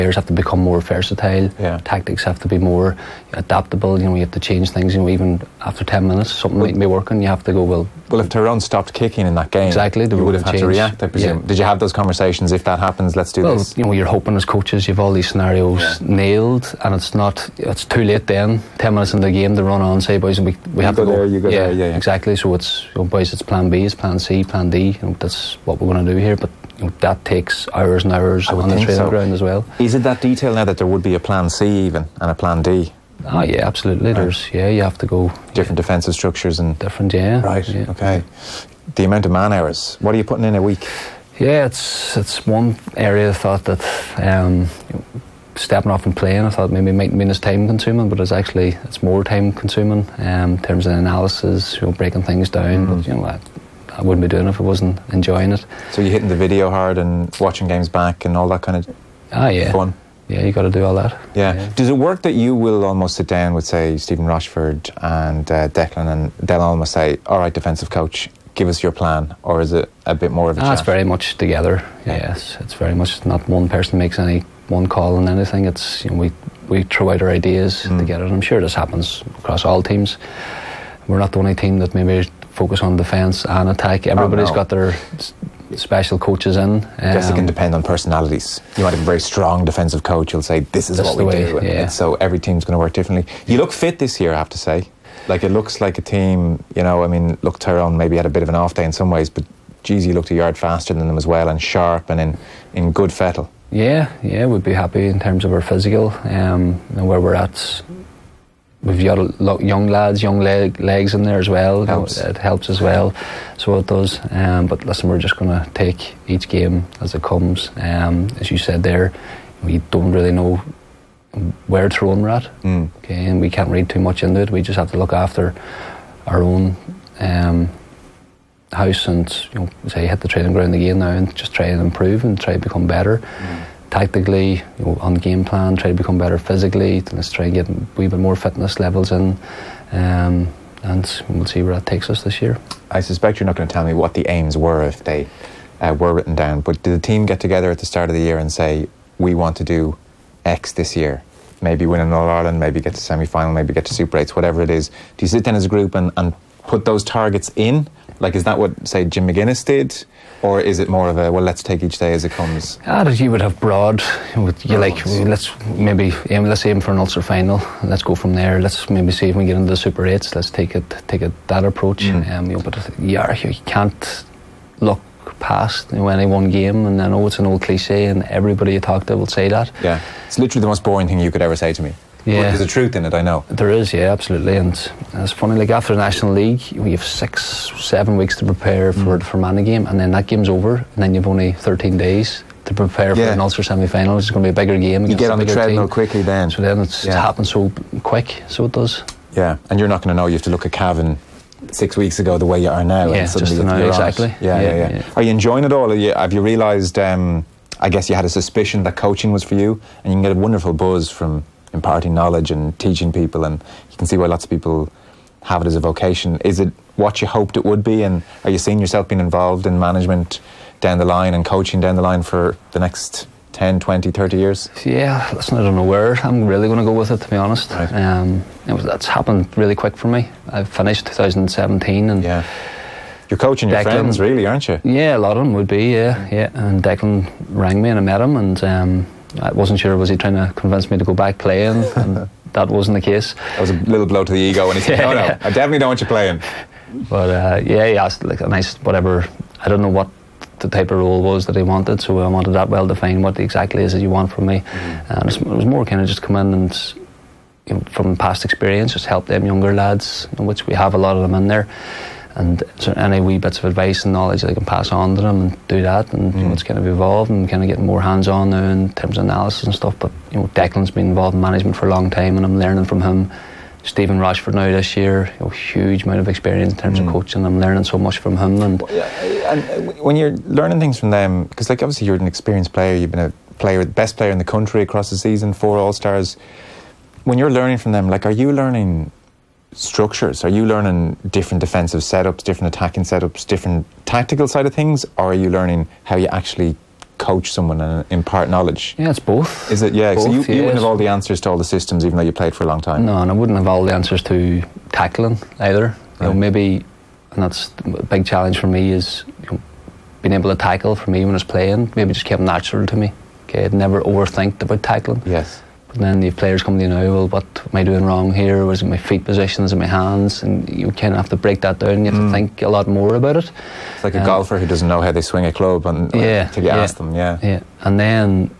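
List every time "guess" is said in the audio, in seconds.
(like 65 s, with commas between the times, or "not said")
87 s, 207 s.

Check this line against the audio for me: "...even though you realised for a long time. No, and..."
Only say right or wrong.
wrong.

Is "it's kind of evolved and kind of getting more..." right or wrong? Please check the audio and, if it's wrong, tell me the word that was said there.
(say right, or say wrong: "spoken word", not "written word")
right.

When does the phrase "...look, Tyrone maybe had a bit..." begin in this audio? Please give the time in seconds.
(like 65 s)
97 s.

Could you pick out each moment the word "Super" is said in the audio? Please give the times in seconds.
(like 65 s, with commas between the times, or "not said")
153 s, 169 s.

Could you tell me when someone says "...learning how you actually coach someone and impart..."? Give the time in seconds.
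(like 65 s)
295 s.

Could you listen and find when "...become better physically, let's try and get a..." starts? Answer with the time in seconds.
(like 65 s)
135 s.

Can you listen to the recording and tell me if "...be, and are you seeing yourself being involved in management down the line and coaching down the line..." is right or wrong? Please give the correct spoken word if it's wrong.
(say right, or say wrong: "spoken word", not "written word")
right.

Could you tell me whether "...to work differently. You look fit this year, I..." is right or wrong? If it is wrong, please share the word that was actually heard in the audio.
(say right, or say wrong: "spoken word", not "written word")
right.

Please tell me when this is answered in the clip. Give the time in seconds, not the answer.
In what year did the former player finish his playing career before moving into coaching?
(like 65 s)
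231 s.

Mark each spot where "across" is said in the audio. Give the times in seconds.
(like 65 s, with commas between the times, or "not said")
79 s, 284 s.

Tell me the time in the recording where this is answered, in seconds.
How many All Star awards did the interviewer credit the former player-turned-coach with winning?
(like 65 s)
285 s.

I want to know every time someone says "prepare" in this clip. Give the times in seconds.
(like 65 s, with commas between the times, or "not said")
188 s, 192 s.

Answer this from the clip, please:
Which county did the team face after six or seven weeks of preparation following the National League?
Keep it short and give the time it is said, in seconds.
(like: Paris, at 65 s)
Fermanagh, at 189 s.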